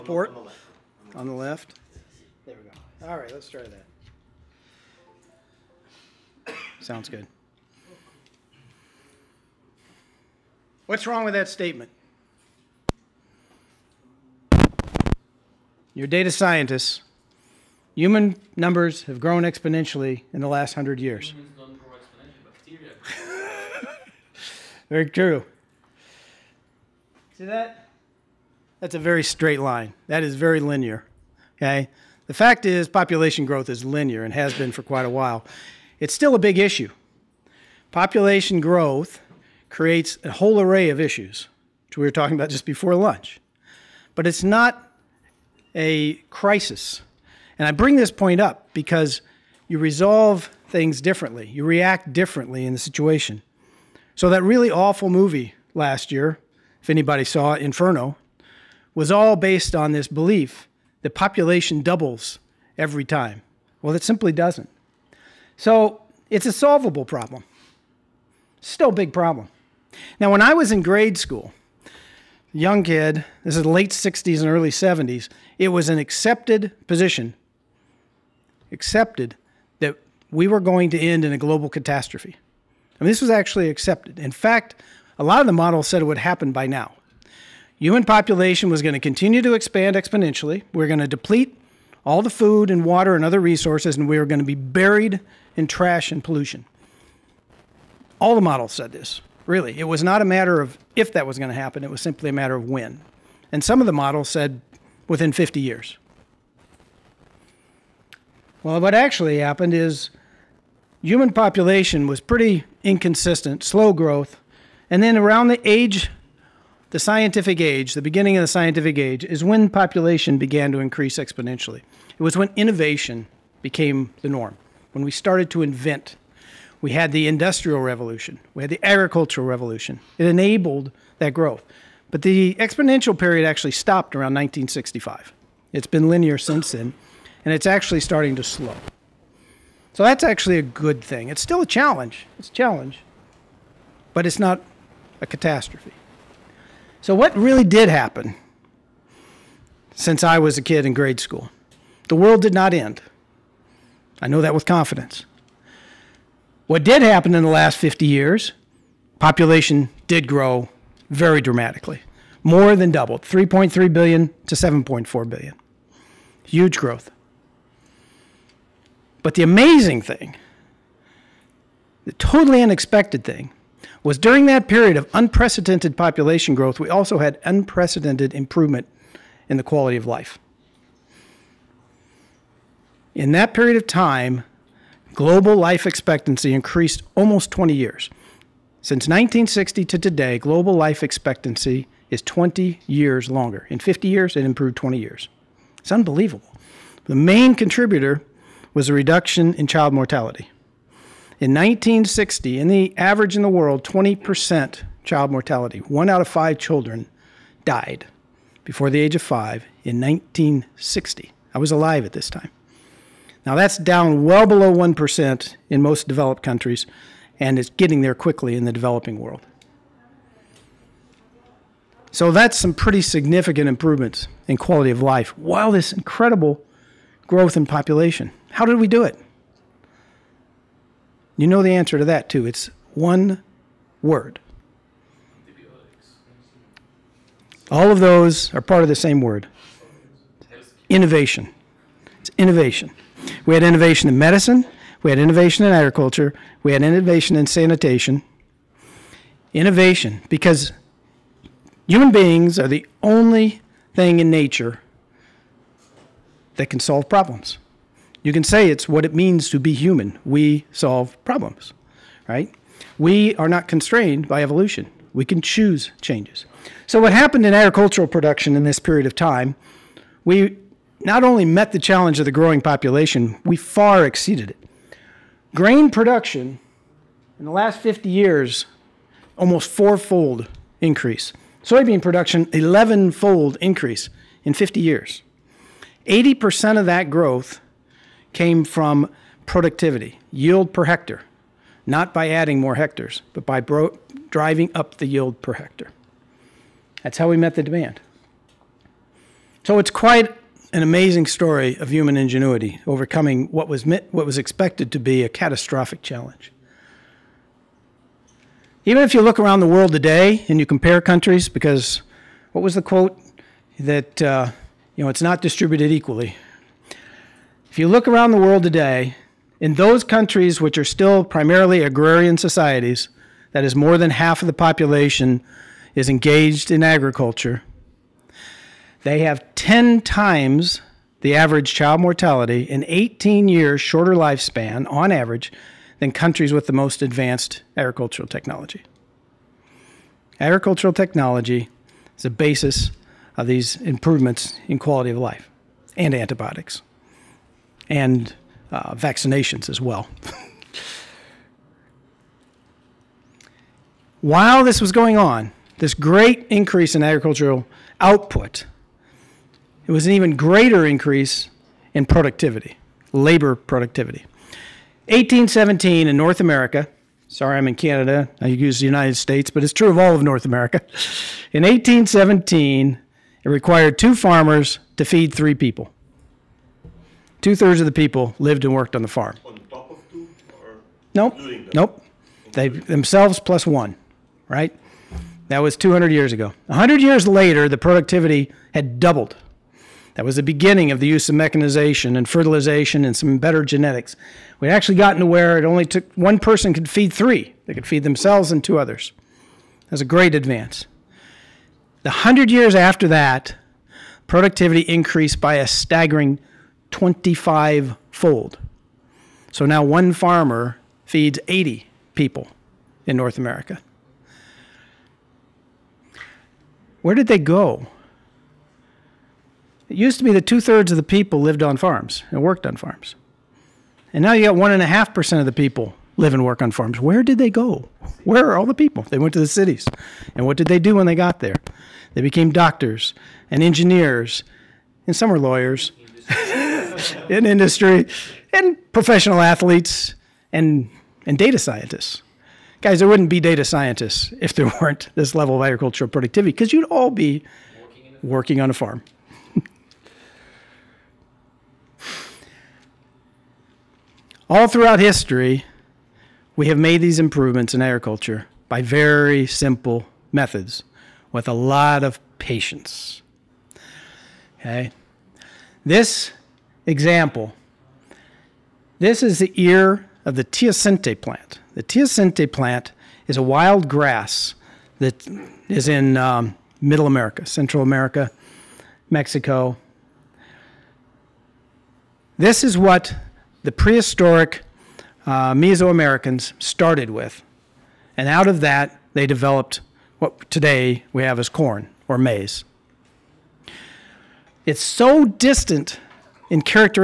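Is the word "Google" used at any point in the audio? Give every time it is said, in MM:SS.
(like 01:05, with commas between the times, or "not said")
not said.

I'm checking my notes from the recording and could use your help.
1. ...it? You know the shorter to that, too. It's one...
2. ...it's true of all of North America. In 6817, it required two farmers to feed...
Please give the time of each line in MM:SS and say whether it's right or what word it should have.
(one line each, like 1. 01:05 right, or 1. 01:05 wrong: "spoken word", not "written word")
1. 03:49 wrong: "answer", not "shorter"
2. 06:09 wrong: "1817", not "6817".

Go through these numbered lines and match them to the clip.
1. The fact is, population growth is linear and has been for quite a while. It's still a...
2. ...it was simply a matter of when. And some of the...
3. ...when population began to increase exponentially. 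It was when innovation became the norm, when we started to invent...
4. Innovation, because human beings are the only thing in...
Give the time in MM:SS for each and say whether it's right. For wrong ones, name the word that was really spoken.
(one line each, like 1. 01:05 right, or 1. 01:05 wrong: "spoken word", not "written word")
1. 00:32 right
2. 01:41 right
3. 01:59 right
4. 04:09 right.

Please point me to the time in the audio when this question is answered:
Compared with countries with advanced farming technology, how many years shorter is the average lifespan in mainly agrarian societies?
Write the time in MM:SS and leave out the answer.
05:32.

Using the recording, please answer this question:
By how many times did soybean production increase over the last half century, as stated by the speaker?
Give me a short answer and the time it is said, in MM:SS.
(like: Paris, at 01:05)
11 fold, at 04:42.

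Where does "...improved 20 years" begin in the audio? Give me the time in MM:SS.
03:14.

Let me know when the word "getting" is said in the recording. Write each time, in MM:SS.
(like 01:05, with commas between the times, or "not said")
03:37.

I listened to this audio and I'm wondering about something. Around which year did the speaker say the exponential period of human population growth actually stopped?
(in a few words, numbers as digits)
1965.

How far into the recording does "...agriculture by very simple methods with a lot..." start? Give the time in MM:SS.
07:37.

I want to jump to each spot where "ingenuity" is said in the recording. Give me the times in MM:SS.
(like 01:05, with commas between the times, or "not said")
05:02.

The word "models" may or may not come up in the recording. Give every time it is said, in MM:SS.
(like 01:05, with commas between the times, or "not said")
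01:25, 01:38, 01:43.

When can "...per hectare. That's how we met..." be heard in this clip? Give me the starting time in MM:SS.
04:55.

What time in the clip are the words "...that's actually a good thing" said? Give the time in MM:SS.
02:20.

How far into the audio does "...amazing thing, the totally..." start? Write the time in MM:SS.
02:49.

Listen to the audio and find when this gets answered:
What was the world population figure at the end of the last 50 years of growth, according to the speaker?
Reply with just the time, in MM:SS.
02:44.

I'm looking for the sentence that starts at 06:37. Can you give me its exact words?
They could feed themselves and two others.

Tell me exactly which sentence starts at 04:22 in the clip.
We are not constrained by evolution.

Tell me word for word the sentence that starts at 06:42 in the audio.
The 100 years after that, productivity increased by a staggering 25 fold.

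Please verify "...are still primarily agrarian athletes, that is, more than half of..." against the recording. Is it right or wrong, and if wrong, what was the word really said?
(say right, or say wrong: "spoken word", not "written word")
wrong: "societies", not "athletes".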